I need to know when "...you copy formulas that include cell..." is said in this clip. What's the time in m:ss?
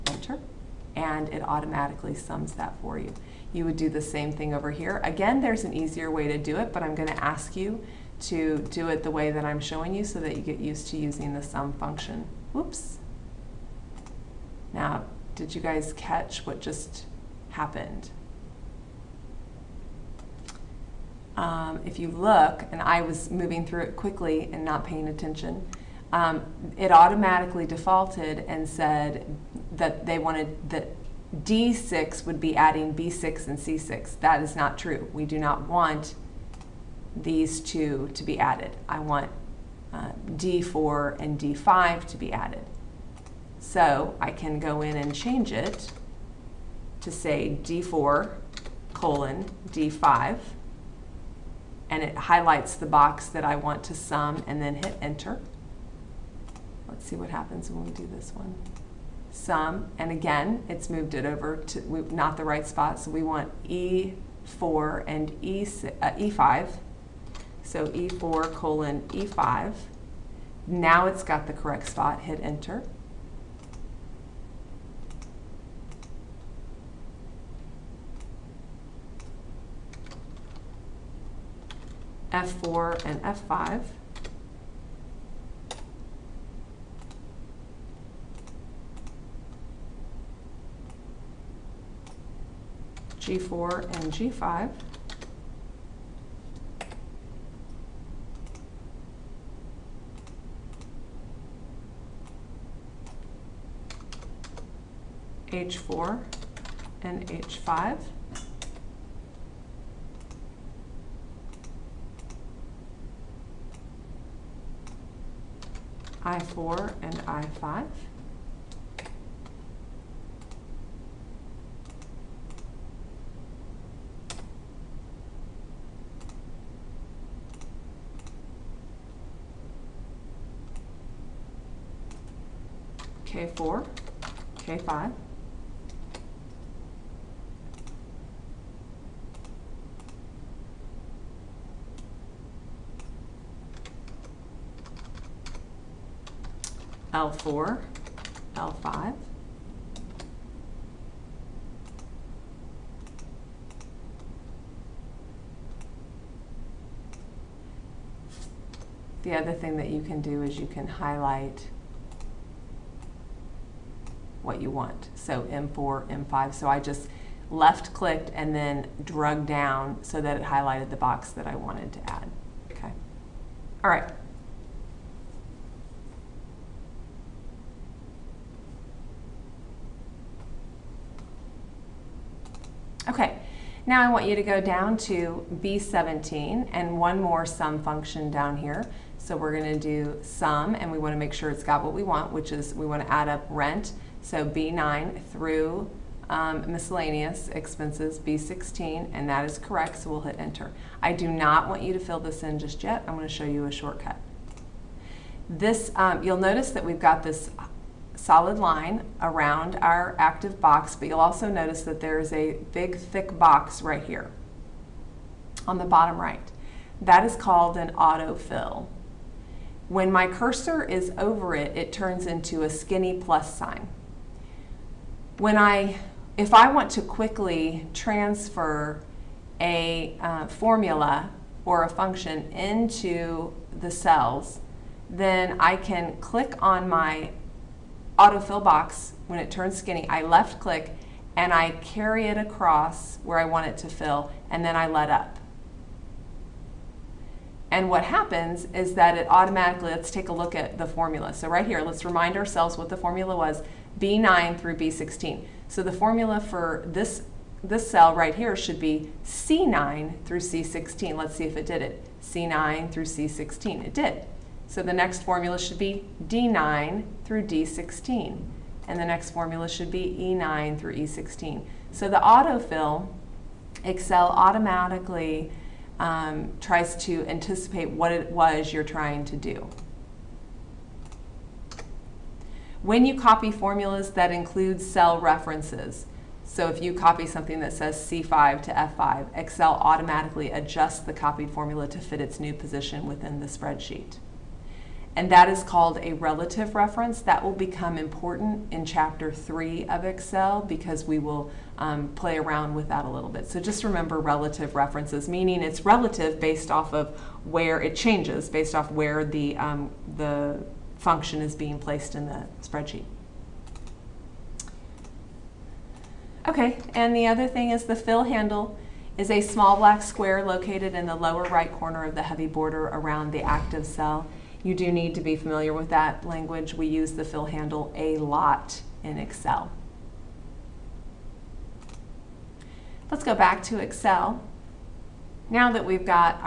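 4:43.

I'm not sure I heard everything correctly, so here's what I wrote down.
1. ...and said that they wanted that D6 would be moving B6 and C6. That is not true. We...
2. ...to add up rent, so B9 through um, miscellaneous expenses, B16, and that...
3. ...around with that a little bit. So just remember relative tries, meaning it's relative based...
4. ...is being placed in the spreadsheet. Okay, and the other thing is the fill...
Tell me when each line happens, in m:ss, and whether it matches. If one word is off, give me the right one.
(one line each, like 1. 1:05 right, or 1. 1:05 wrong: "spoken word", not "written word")
1. 0:28 wrong: "adding", not "moving"
2. 3:13 right
3. 5:02 wrong: "references", not "tries"
4. 5:11 right.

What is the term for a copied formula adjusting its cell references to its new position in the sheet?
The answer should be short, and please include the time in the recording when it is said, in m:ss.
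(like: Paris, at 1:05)
relative reference, at 4:56.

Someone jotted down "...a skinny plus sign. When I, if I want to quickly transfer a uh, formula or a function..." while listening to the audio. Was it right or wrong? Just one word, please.
right.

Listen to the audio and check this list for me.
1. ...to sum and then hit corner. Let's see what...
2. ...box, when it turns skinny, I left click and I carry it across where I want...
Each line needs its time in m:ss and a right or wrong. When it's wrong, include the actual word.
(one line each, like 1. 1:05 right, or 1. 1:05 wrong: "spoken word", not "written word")
1. 0:53 wrong: "enter", not "corner"
2. 3:58 right.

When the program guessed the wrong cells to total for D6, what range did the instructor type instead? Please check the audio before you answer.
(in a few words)
D4:D5.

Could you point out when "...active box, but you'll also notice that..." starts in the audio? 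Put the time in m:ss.
3:30.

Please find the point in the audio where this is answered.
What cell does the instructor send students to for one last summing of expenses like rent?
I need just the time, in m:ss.
3:05.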